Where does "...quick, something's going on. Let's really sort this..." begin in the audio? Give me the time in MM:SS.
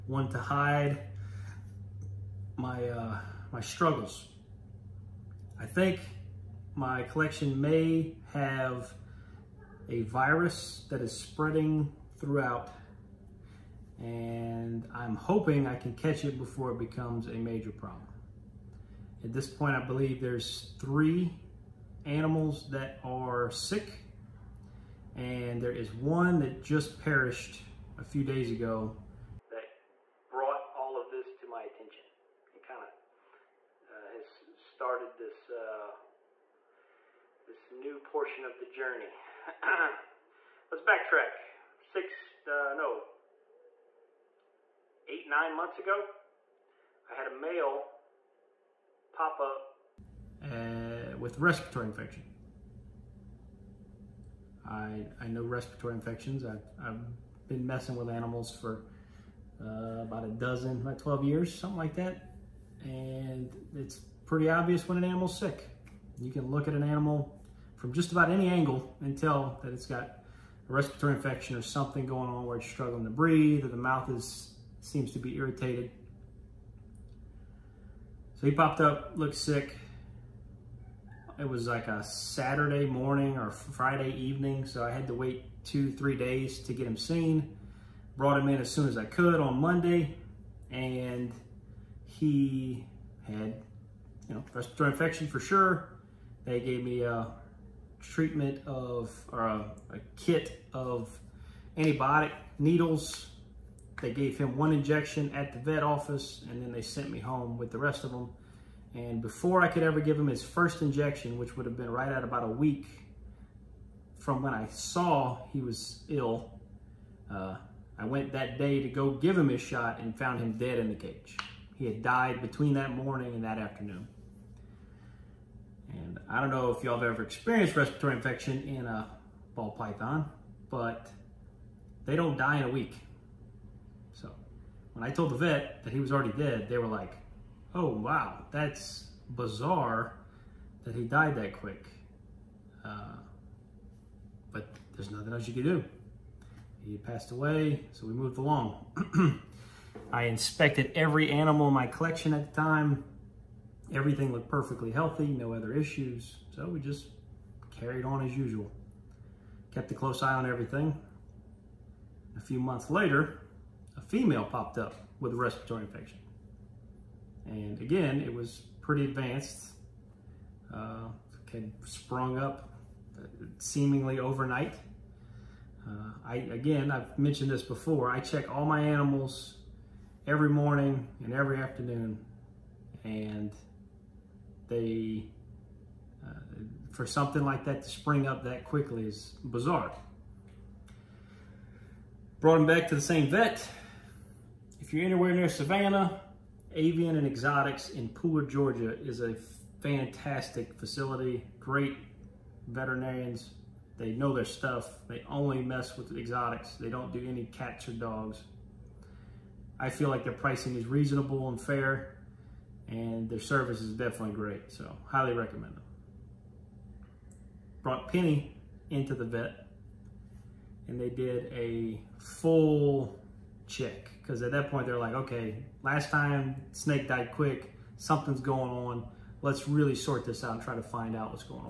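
03:47.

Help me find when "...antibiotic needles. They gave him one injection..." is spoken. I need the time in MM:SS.
01:41.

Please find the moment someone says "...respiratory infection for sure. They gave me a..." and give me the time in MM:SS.
01:34.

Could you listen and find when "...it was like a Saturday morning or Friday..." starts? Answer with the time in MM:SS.
01:21.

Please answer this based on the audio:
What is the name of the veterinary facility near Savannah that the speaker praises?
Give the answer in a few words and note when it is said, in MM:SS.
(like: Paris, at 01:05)
Avian and Exotics, at 03:16.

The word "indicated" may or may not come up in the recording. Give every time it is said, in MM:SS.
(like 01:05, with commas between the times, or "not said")
not said.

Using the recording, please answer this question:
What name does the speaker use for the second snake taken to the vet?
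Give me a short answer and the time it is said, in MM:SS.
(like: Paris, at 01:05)
Penny, at 03:38.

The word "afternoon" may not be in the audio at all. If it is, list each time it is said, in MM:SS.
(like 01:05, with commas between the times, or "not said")
02:03, 03:01.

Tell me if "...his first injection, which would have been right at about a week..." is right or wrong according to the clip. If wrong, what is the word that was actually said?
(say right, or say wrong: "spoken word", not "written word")
right.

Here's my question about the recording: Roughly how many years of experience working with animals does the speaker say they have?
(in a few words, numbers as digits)
12.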